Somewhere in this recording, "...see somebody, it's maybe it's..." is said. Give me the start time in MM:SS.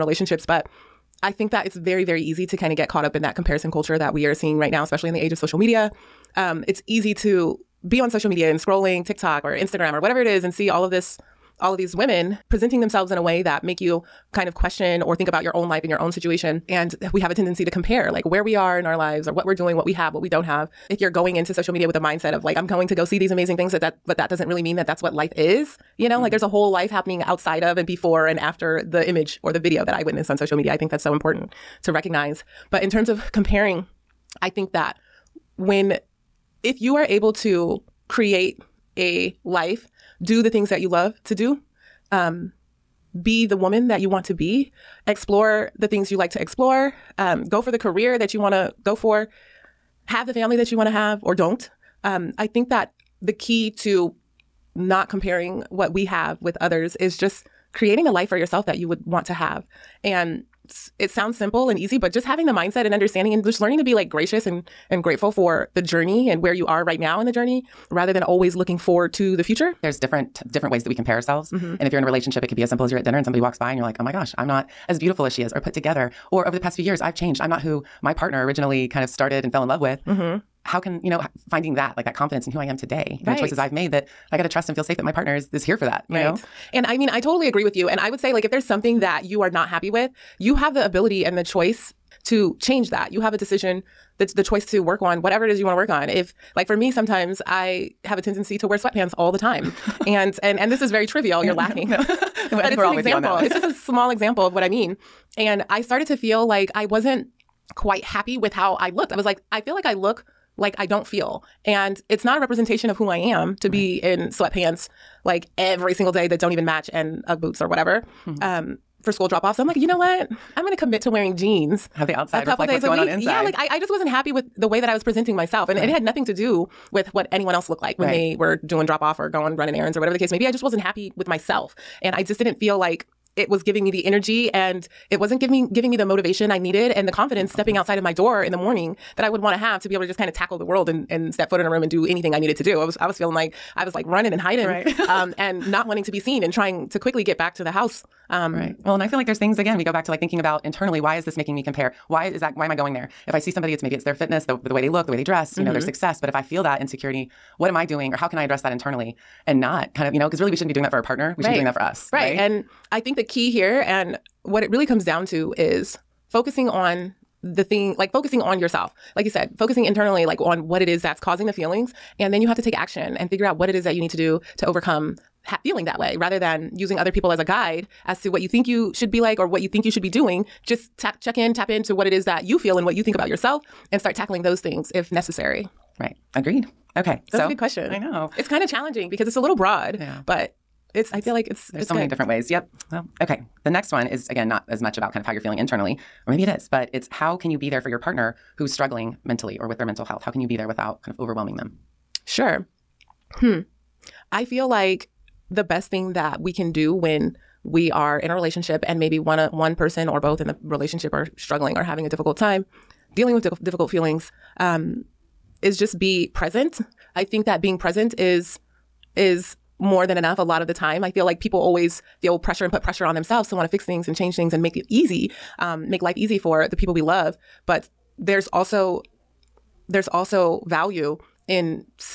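02:33.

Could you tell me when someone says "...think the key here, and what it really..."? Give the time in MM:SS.
02:42.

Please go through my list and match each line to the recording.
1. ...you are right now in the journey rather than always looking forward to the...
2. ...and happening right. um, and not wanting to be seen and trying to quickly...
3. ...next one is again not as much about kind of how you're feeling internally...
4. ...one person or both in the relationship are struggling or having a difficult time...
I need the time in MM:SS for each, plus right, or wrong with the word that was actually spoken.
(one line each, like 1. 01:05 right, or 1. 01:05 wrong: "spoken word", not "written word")
1. 01:06 right
2. 02:24 wrong: "hiding", not "happening"
3. 03:13 right
4. 03:29 right.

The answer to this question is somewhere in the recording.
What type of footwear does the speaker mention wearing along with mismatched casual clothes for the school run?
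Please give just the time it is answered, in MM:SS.
01:57.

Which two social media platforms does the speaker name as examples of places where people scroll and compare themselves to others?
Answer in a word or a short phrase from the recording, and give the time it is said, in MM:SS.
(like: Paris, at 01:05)
TikTok or Instagram, at 00:09.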